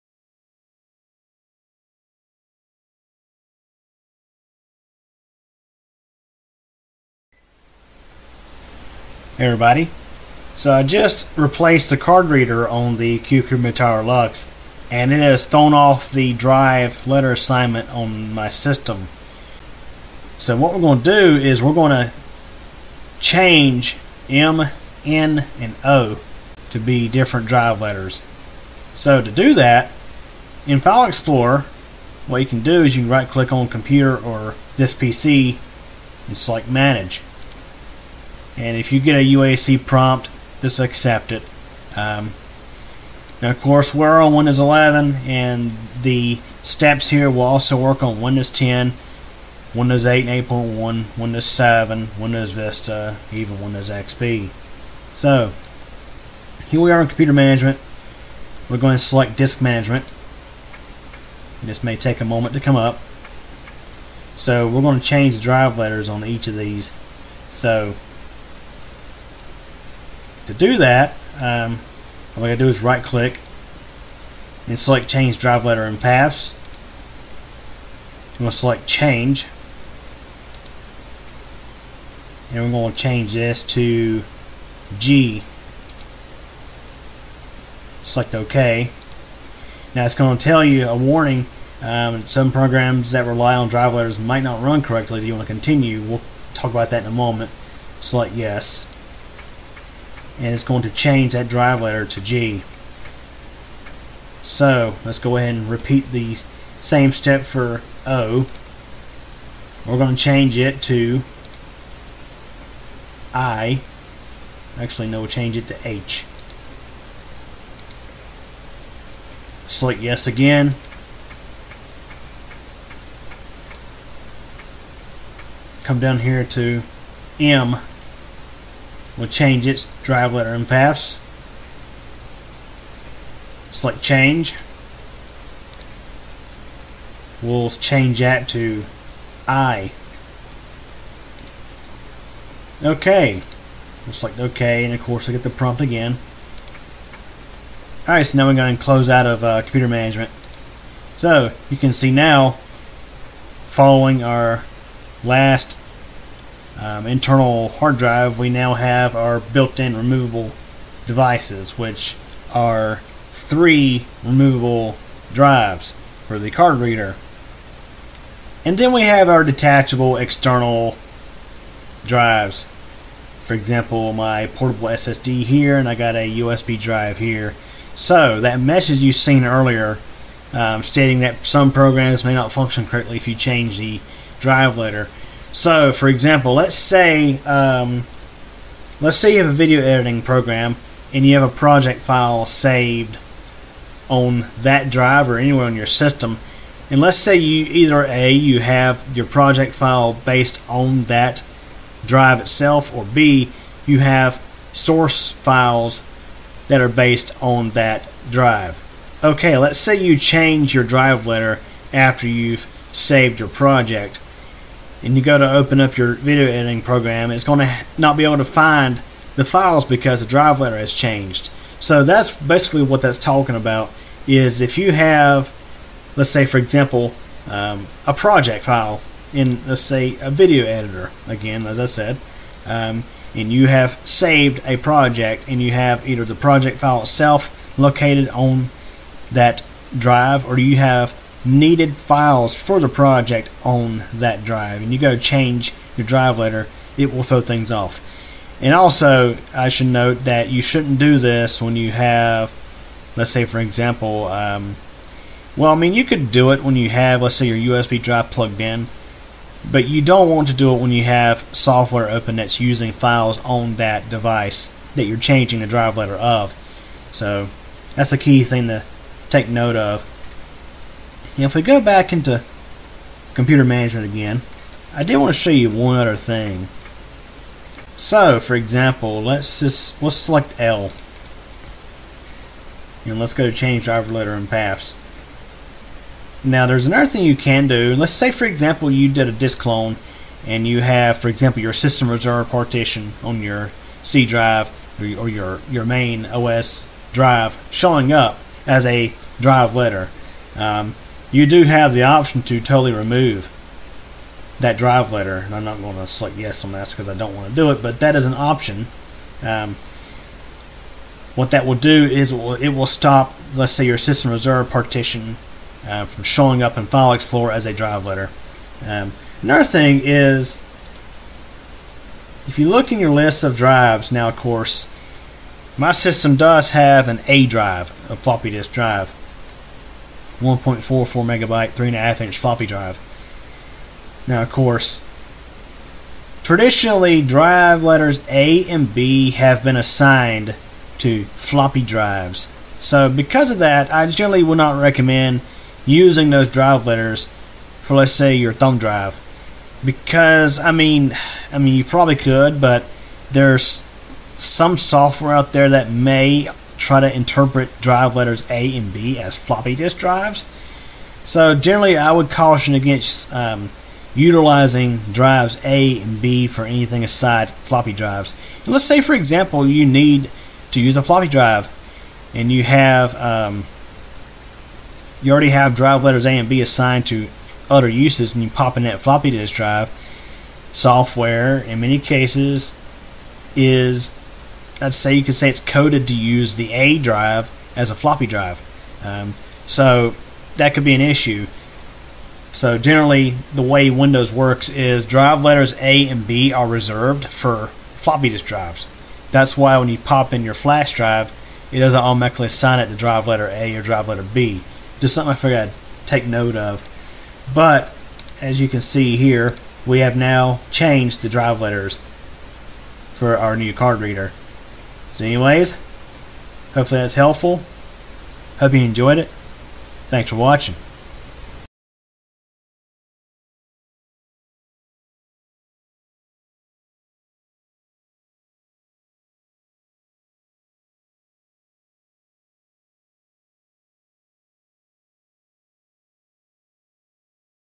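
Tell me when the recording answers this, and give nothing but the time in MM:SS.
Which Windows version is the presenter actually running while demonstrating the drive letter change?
00:44.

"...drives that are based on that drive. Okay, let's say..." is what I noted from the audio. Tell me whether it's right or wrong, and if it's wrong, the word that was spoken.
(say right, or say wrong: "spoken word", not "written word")
wrong: "files", not "drives".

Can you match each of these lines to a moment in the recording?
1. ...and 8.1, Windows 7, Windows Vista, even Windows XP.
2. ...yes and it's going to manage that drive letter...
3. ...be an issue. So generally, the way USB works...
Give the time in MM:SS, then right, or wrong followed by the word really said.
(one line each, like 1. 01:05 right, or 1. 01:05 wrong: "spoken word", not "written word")
1. 00:50 right
2. 01:38 wrong: "change", not "manage"
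3. 06:30 wrong: "Windows", not "USB".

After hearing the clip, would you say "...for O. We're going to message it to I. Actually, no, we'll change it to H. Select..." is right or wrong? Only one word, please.
wrong.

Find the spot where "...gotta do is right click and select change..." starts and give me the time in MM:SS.
01:12.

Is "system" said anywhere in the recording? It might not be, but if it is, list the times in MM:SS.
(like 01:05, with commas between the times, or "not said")
00:18, 03:15, 04:51, 05:13, 05:25.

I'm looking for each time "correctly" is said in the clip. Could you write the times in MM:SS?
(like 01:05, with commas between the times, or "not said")
01:34, 03:02.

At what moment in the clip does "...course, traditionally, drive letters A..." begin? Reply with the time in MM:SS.
05:34.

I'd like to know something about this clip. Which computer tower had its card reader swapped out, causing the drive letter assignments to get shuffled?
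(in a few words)
Cucumber Tower Lux.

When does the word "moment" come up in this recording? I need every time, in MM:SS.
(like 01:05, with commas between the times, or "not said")
01:02, 01:37.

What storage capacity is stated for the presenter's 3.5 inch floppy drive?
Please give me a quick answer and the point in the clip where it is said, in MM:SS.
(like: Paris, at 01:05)
1.44 megabyte, at 05:30.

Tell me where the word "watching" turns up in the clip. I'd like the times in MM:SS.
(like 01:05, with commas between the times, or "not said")
07:00.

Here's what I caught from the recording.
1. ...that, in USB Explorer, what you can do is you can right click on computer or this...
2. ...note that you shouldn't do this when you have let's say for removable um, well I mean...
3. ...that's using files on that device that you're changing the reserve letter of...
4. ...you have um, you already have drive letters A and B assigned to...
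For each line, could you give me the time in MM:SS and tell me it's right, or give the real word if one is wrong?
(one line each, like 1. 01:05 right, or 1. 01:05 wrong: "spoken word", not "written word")
1. 00:29 wrong: "File", not "USB"
2. 04:09 wrong: "example", not "removable"
3. 04:22 wrong: "drive", not "reserve"
4. 06:12 right.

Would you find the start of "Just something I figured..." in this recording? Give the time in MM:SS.
06:44.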